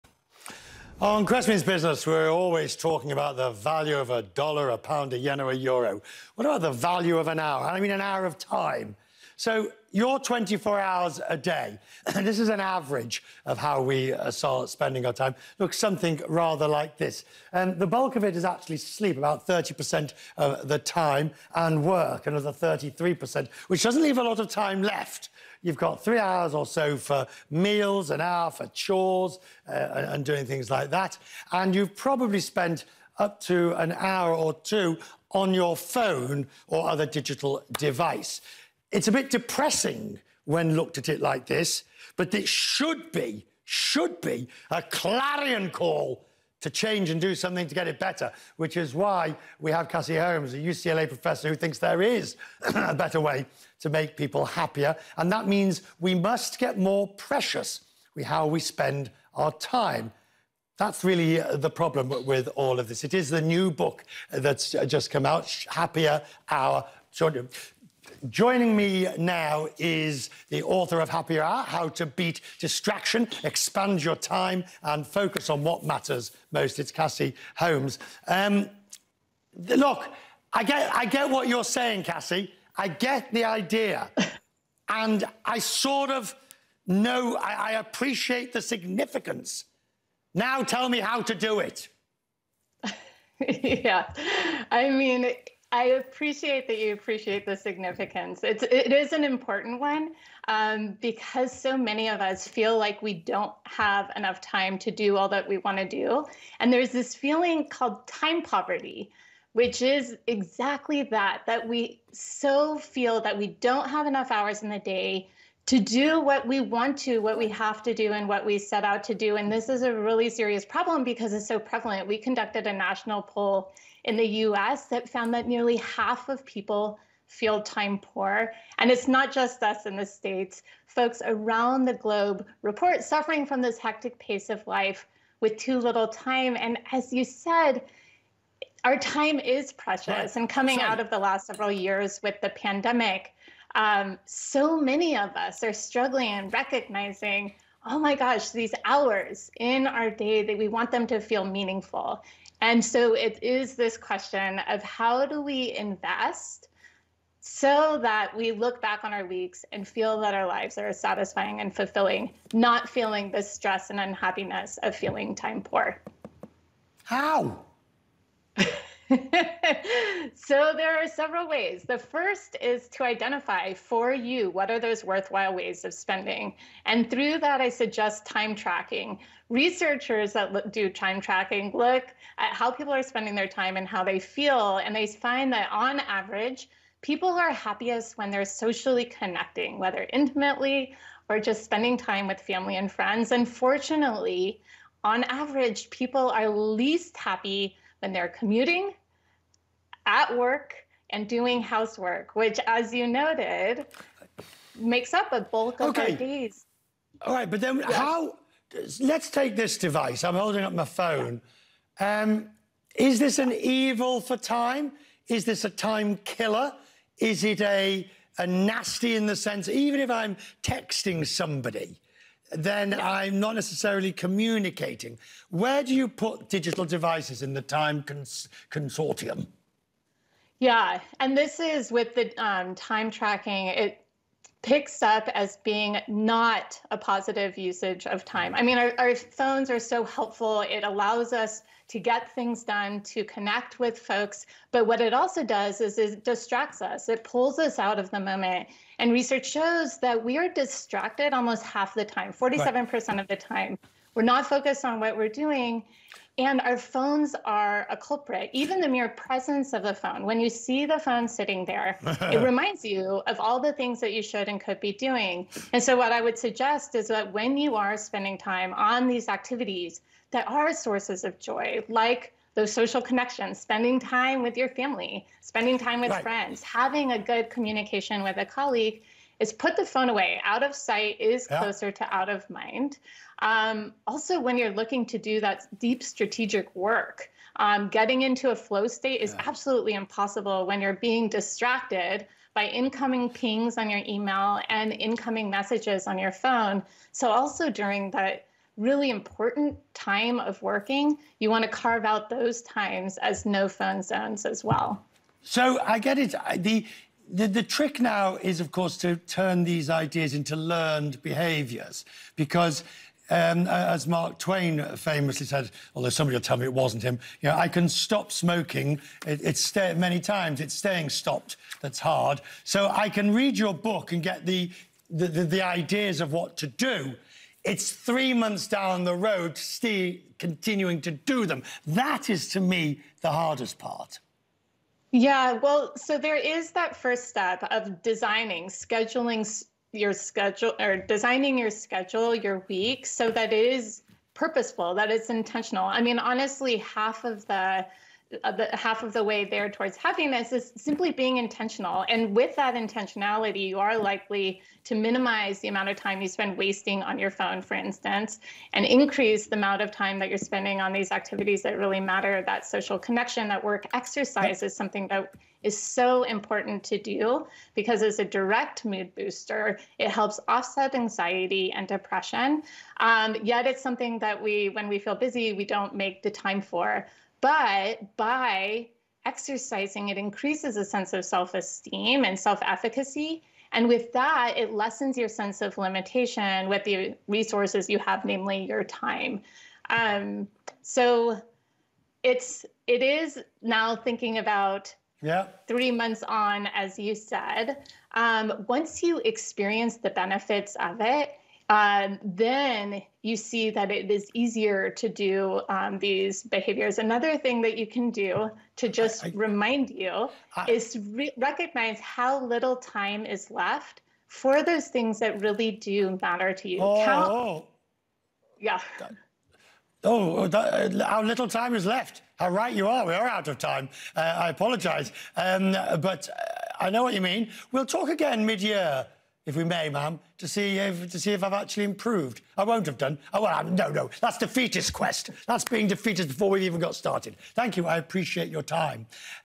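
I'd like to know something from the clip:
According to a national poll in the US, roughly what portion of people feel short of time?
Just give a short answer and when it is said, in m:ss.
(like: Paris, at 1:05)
nearly half, at 2:05.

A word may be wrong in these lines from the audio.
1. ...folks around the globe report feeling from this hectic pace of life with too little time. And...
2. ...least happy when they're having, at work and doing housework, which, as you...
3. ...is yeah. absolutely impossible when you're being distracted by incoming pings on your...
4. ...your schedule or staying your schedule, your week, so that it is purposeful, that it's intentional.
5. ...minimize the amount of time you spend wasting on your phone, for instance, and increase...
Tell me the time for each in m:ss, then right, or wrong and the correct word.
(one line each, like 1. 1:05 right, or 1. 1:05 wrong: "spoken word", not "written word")
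1. 2:10 wrong: "suffering", not "feeling"
2. 3:16 wrong: "commuting", not "having"
3. 4:49 right
4. 5:39 wrong: "designing", not "staying"
5. 5:54 right.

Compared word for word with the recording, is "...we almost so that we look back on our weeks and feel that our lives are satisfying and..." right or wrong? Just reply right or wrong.
wrong.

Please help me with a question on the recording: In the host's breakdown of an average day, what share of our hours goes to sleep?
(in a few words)
30%.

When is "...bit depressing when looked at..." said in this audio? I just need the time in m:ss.
0:39.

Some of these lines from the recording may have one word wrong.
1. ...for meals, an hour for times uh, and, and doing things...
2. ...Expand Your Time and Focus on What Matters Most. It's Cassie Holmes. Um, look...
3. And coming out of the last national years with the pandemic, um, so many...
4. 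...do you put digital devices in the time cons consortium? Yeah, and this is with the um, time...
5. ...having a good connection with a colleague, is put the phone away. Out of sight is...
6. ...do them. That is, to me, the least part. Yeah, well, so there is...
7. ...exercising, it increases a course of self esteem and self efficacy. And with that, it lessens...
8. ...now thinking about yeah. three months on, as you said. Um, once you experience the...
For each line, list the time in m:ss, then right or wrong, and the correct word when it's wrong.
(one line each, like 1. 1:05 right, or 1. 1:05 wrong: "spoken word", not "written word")
1. 0:26 wrong: "chores", not "times"
2. 1:13 right
3. 2:20 wrong: "several", not "national"
4. 3:45 right
5. 4:36 wrong: "communication", not "connection"
6. 5:31 wrong: "hardest", not "least"
7. 6:19 wrong: "sense", not "course"
8. 6:33 right.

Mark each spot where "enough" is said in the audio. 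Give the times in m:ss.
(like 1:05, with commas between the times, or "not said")
1:44, 1:54.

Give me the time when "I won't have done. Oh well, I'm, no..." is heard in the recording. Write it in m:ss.
7:12.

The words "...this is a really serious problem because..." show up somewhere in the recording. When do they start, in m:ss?
1:59.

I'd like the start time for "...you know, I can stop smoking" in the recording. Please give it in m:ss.
5:17.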